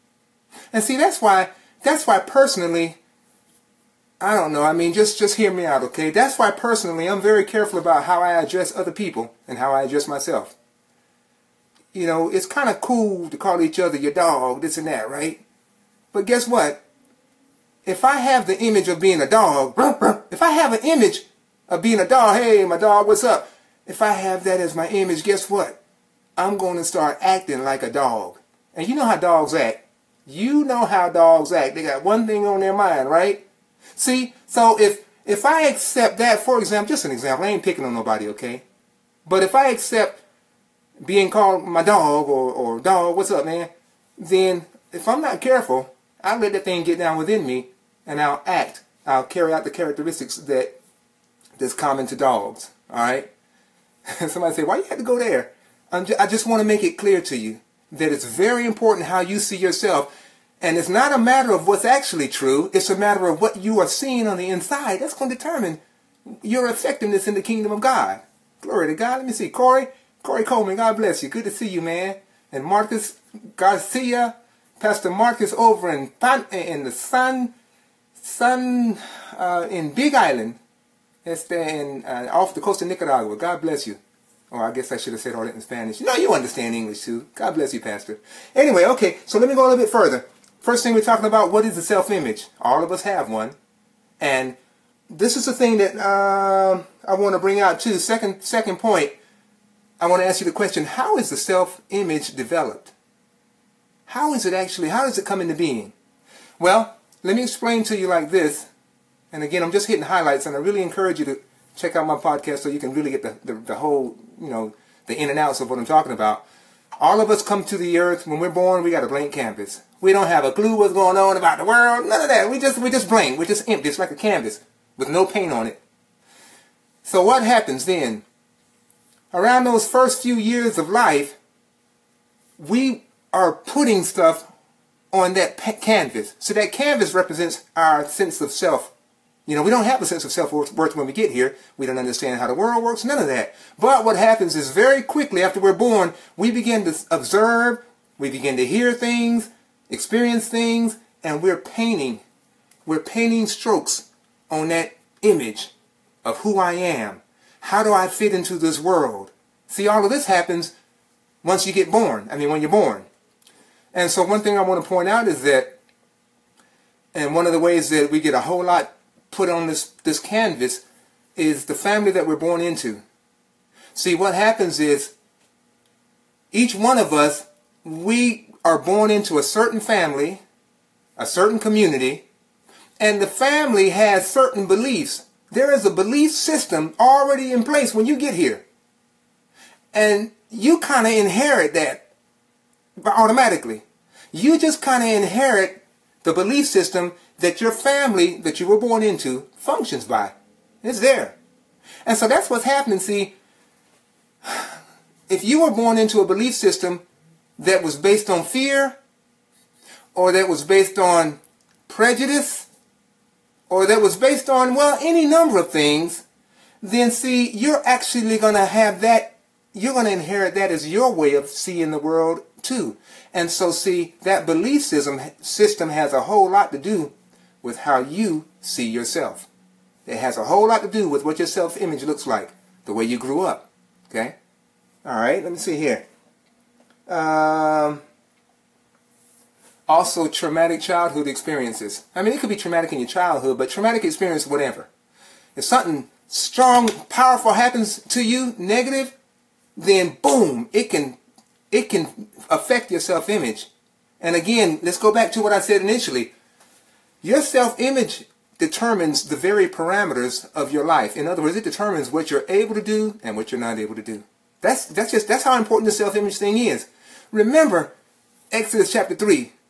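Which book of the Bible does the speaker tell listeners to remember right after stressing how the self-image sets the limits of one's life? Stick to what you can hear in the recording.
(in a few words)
Exodus.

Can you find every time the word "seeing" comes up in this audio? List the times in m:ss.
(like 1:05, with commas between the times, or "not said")
1:03, 3:41.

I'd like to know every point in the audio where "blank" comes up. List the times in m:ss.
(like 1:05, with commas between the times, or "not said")
1:59, 2:03.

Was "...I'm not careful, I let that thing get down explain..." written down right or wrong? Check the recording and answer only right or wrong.
wrong.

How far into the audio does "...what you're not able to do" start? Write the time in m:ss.
4:23.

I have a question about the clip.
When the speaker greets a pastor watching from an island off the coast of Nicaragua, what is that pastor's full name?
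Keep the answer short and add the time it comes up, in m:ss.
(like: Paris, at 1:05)
Marcus Garcia, at 1:12.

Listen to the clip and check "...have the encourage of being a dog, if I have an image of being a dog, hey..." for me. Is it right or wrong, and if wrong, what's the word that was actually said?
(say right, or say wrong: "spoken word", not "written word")
wrong: "image", not "encourage".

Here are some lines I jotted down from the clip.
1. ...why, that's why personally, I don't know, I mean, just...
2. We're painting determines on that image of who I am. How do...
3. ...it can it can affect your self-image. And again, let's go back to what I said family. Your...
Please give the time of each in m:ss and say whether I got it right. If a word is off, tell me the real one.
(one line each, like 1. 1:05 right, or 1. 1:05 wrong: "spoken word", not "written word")
1. 0:01 right
2. 2:32 wrong: "strokes", not "determines"
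3. 4:10 wrong: "initially", not "family".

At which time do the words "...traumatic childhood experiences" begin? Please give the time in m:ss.
4:00.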